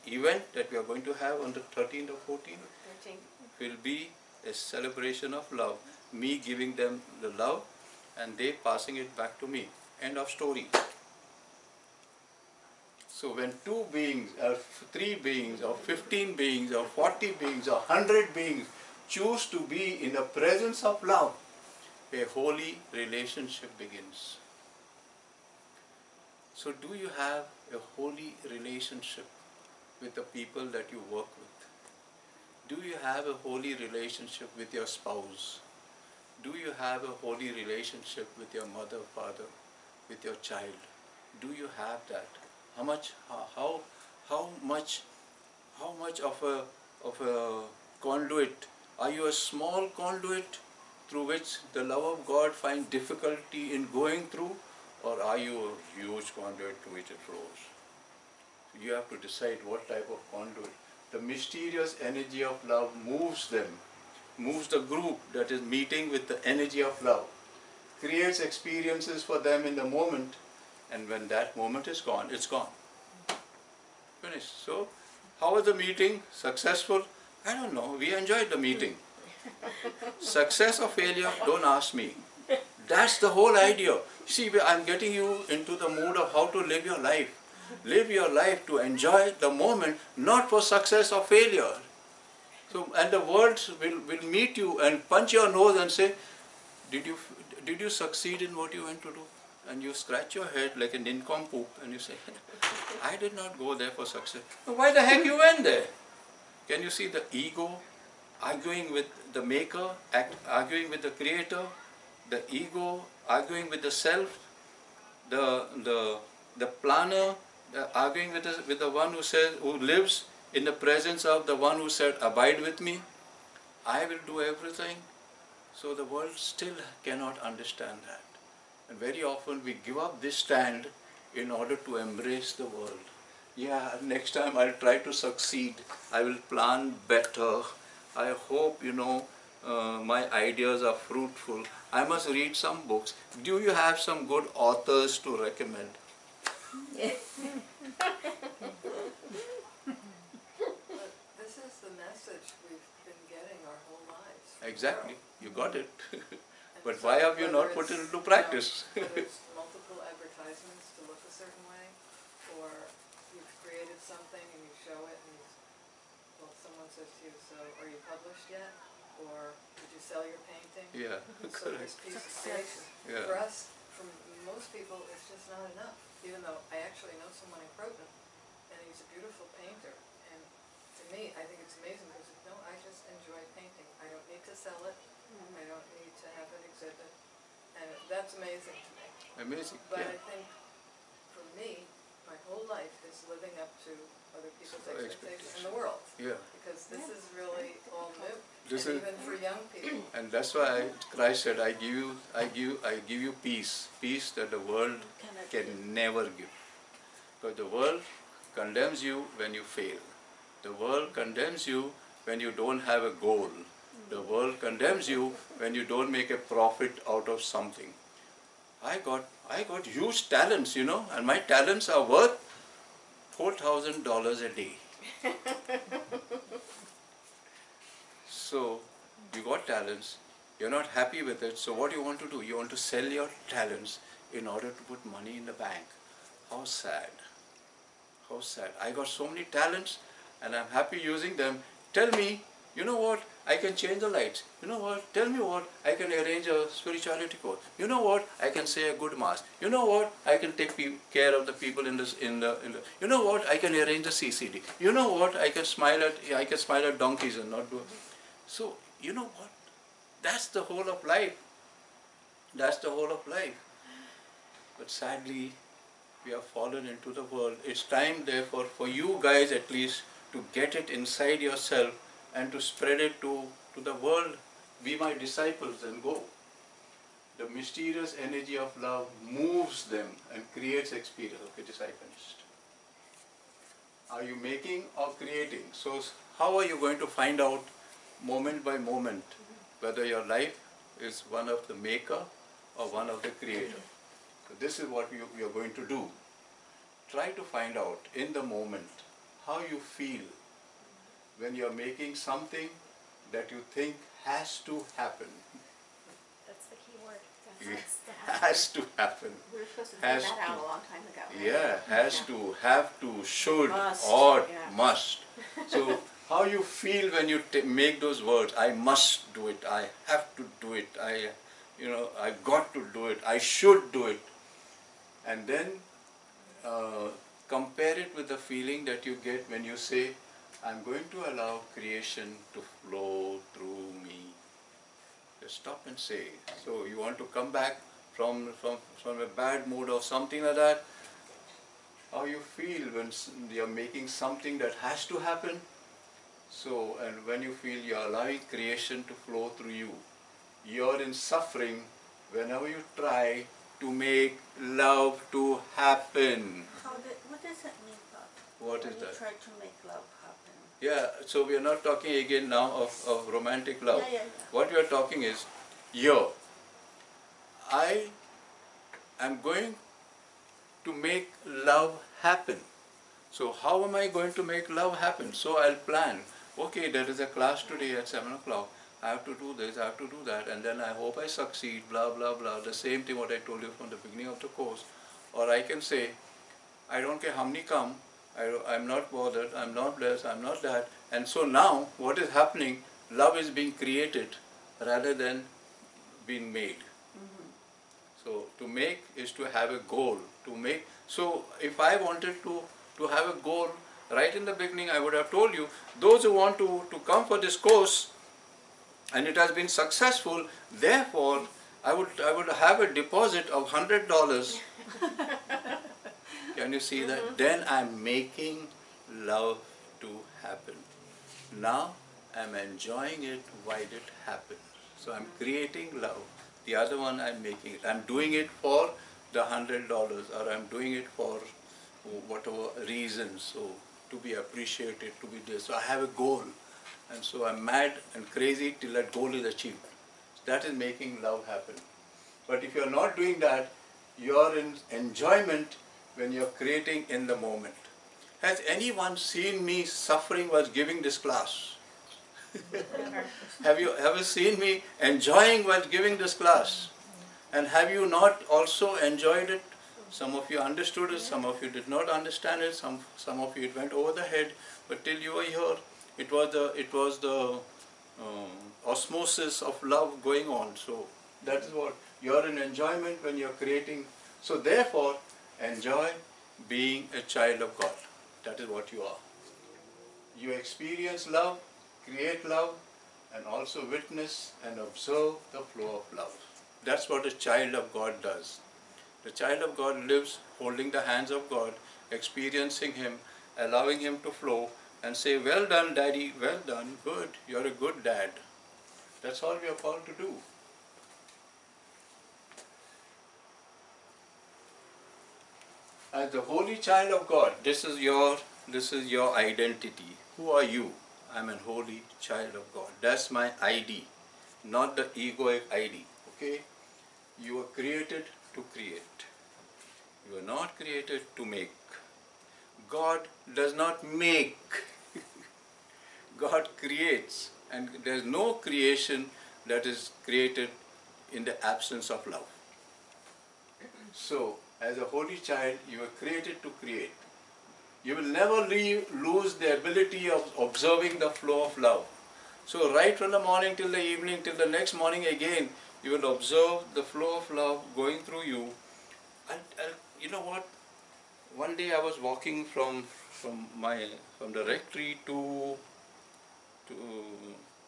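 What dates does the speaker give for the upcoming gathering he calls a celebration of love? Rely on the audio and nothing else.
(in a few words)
13th or 14th.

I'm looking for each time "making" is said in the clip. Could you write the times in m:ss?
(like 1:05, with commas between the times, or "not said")
4:44, 5:01, 5:43, 6:58, 7:07, 7:20.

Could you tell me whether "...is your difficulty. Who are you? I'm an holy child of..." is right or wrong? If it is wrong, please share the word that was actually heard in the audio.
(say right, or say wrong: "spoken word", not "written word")
wrong: "identity", not "difficulty".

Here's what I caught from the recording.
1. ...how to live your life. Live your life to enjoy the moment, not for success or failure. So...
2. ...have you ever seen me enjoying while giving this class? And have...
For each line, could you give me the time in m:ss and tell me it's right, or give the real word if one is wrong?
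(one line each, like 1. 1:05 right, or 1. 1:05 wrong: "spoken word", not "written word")
1. 1:26 right
2. 7:33 right.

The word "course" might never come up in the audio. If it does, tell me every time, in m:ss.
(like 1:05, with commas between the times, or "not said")
4:07, 6:24, 6:47.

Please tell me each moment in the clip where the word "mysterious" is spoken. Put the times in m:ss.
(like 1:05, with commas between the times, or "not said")
1:01, 4:37.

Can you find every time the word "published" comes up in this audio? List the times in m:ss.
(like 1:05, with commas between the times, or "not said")
2:48.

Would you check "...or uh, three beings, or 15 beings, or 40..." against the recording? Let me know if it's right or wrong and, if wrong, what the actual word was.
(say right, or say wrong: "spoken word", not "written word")
right.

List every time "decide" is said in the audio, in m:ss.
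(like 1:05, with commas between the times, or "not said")
0:59.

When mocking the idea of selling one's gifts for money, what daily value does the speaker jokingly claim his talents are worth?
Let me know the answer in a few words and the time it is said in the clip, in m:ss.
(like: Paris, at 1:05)
$4,000 a day, at 3:43.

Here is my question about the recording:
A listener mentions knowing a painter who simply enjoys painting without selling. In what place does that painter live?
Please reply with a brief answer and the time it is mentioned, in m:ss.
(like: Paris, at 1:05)
Croton, at 2:57.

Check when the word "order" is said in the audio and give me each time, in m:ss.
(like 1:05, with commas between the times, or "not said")
2:11, 3:54.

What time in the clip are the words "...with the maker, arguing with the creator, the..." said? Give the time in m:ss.
1:48.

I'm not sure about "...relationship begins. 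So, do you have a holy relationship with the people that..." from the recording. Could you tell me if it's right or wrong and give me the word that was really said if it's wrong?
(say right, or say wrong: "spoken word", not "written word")
right.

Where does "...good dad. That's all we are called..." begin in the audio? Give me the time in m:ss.
8:17.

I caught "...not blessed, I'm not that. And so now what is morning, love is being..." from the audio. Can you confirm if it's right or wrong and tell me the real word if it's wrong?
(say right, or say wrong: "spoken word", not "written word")
wrong: "happening", not "morning".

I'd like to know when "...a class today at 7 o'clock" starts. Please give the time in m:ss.
6:17.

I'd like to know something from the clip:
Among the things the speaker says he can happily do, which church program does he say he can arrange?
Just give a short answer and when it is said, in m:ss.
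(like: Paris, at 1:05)
CCD, at 4:14.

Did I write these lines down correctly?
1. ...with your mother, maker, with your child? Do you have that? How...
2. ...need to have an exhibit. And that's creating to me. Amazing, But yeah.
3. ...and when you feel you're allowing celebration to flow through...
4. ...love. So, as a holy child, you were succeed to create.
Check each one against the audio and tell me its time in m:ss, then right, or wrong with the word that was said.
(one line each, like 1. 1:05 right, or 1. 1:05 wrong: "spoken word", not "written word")
1. 0:38 wrong: "father", not "maker"
2. 3:05 wrong: "amazing", not "creating"
3. 5:47 wrong: "creation", not "celebration"
4. 8:52 wrong: "created", not "succeed".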